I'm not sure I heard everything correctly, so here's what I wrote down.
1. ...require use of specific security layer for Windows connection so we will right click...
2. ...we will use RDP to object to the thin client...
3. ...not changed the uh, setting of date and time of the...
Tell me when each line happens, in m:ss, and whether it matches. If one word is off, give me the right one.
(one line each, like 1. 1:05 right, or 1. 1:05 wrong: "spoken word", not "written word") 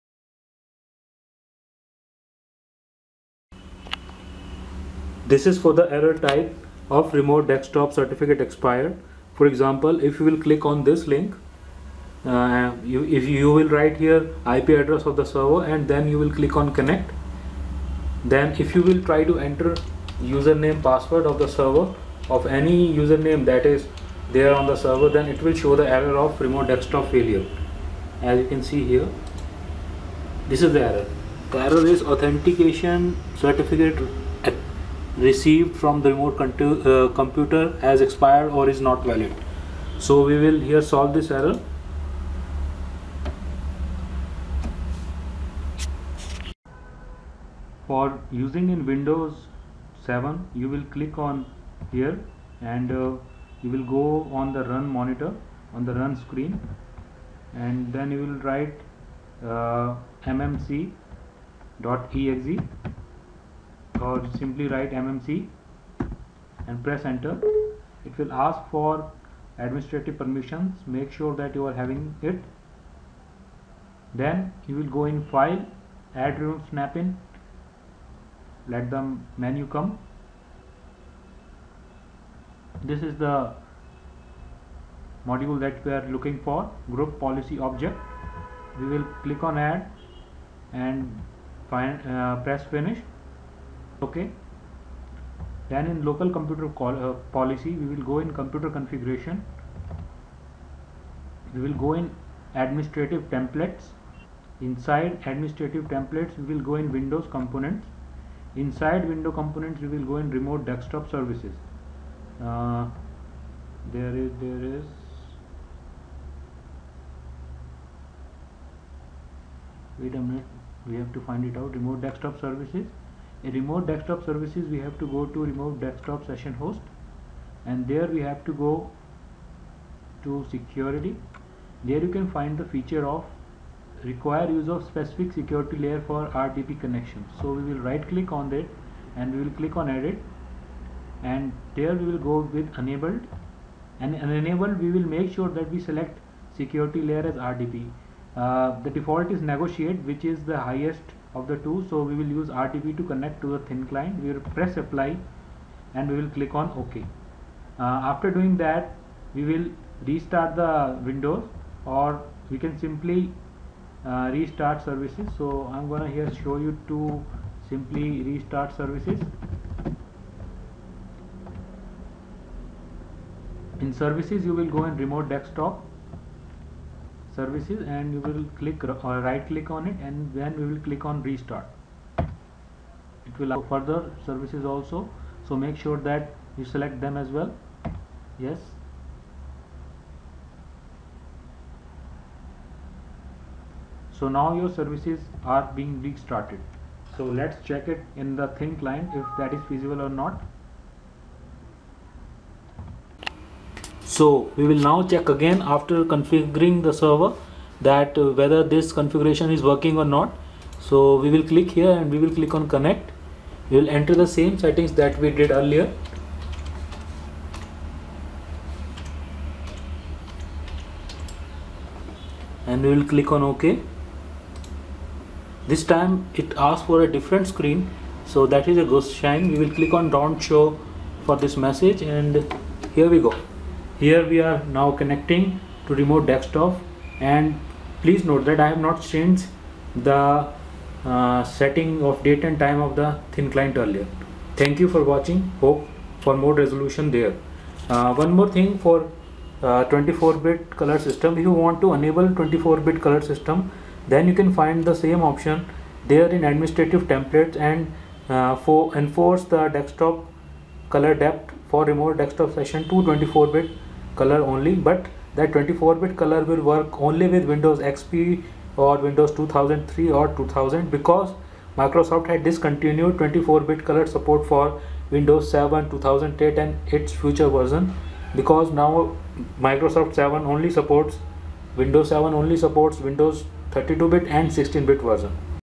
1. 2:14 wrong: "RDP", not "Windows"
2. 2:32 wrong: "connect", not "object"
3. 3:58 right.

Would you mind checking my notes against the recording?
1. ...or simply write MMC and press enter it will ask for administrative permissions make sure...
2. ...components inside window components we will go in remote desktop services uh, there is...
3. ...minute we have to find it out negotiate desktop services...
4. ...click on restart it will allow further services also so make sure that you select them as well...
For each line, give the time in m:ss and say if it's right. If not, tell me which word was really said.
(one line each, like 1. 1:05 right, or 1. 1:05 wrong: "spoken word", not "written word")
1. 1:04 right
2. 1:47 right
3. 2:00 wrong: "remote", not "negotiate"
4. 3:00 right.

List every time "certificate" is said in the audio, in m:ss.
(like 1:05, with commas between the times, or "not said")
0:07, 0:33.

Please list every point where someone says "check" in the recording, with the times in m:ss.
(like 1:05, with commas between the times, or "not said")
3:17, 3:25.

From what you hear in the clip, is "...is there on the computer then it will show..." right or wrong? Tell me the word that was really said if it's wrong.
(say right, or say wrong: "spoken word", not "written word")
wrong: "server", not "computer".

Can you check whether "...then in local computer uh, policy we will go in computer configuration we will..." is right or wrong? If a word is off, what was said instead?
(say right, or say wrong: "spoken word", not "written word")
right.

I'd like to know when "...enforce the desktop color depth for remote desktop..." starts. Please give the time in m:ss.
4:18.